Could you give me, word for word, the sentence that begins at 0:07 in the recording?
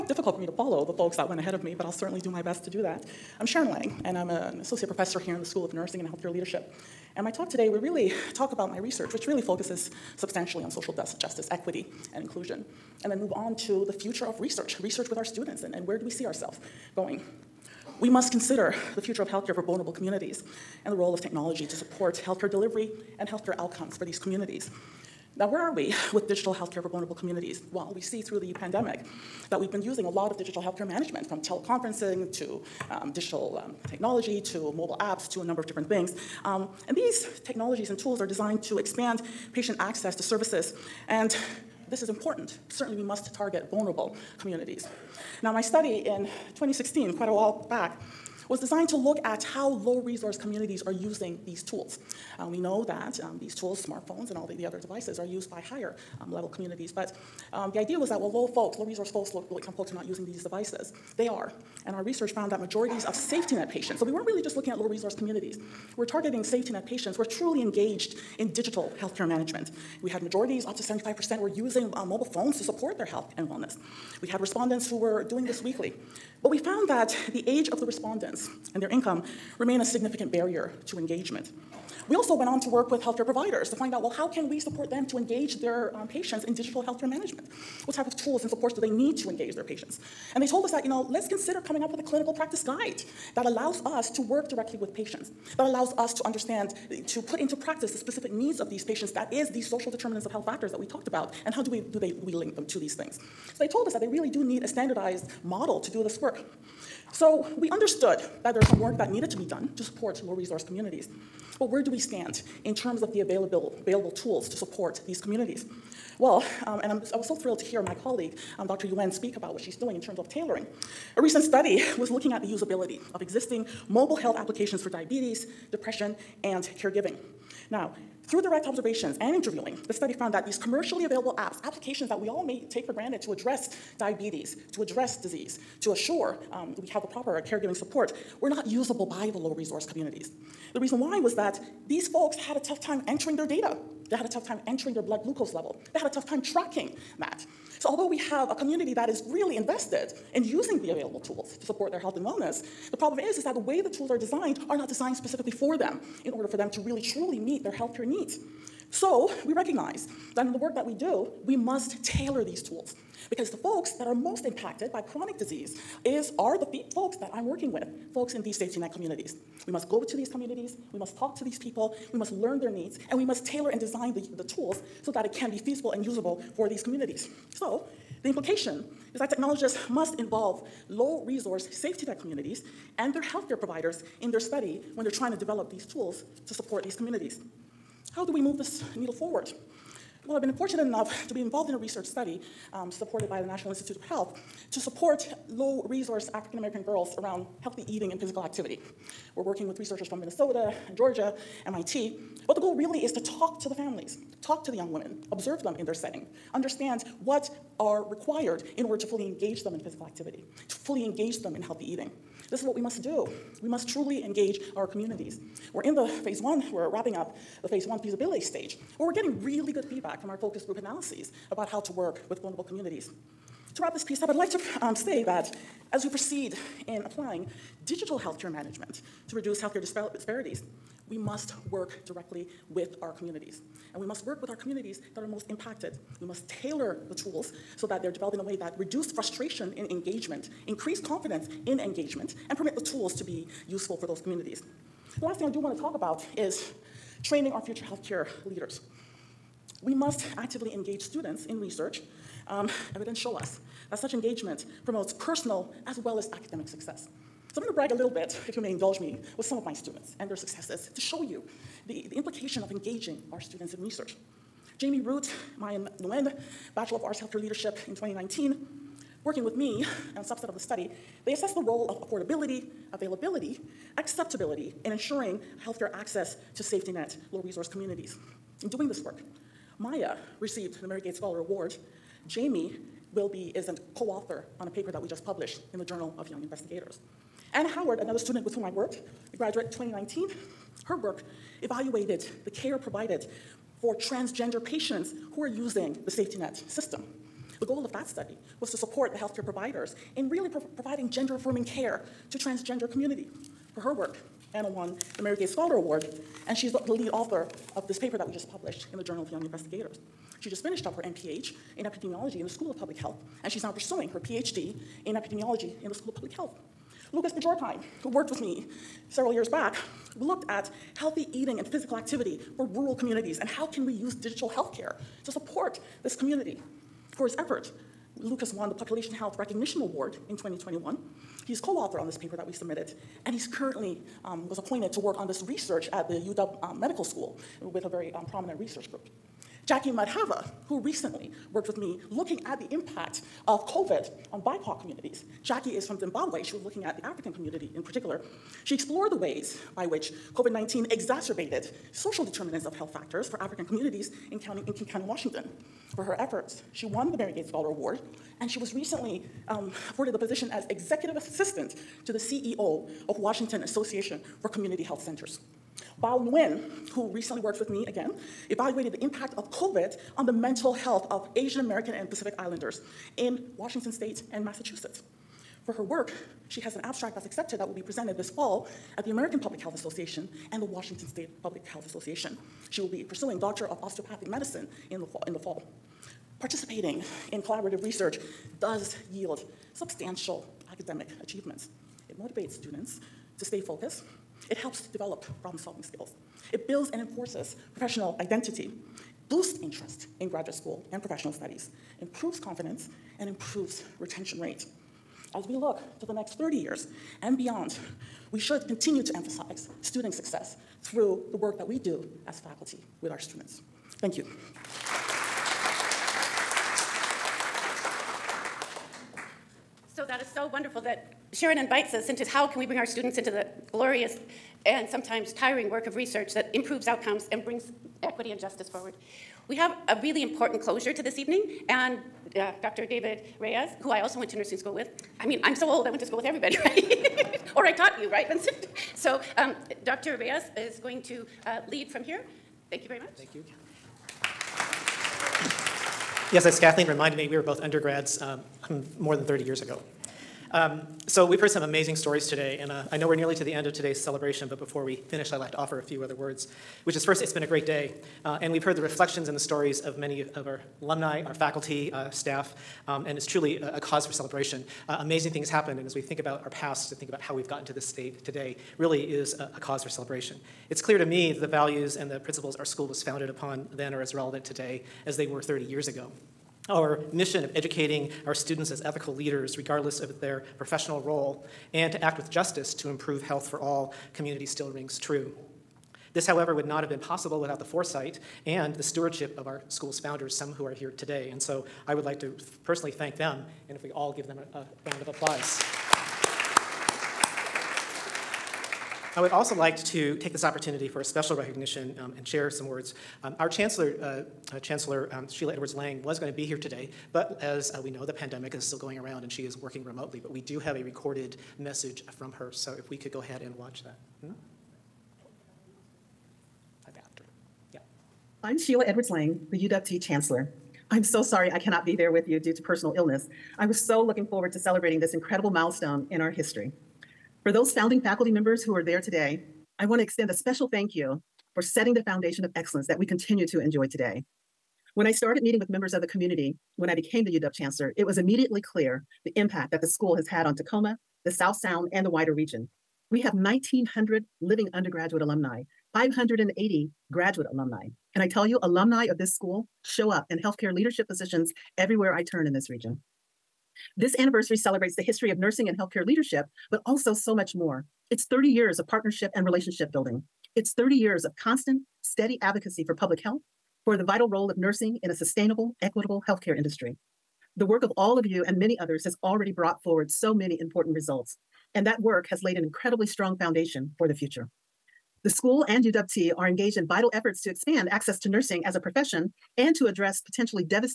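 And my talk today will really talk about my research, which really focuses substantially on social justice, equity, and inclusion.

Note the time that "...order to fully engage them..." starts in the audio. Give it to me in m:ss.
3:28.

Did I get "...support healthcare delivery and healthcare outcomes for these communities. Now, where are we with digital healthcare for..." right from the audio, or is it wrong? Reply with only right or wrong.
right.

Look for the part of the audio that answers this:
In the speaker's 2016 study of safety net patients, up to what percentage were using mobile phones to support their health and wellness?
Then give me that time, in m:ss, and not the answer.
1:10.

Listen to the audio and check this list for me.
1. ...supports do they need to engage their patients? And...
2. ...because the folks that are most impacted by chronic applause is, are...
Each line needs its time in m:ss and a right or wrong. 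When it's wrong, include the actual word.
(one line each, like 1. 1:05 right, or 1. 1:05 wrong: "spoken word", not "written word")
1. 1:28 right
2. 2:43 wrong: "disease", not "applause".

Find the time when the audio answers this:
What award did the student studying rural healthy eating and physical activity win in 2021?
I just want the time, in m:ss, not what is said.
5:28.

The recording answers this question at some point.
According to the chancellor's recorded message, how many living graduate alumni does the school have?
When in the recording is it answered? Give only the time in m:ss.
9:05.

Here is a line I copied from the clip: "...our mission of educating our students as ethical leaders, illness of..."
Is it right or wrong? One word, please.
wrong.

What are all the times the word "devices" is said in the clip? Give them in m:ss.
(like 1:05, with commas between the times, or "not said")
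0:54, 1:00.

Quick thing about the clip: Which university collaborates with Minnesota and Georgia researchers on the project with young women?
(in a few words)
MIT.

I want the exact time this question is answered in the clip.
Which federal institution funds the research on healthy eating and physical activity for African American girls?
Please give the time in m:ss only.
3:13.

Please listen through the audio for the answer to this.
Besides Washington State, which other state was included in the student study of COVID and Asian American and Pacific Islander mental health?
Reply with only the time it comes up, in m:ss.
6:14.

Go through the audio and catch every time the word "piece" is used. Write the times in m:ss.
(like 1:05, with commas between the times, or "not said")
3:44.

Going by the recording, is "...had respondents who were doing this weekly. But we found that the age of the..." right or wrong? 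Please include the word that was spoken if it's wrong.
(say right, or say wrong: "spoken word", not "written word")
right.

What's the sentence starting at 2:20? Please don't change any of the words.
The reason why was that these folks had a tough time entering their data.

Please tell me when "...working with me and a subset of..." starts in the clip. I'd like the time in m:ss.
4:29.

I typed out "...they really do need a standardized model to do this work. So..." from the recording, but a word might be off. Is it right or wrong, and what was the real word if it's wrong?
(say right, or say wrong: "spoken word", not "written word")
right.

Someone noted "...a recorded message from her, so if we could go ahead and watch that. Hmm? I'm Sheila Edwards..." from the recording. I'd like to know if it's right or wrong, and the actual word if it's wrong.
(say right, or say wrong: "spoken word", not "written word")
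right.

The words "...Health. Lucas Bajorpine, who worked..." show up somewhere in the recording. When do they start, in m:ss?
5:16.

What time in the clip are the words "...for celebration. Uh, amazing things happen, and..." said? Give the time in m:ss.
7:44.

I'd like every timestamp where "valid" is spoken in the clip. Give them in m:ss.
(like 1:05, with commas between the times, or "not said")
not said.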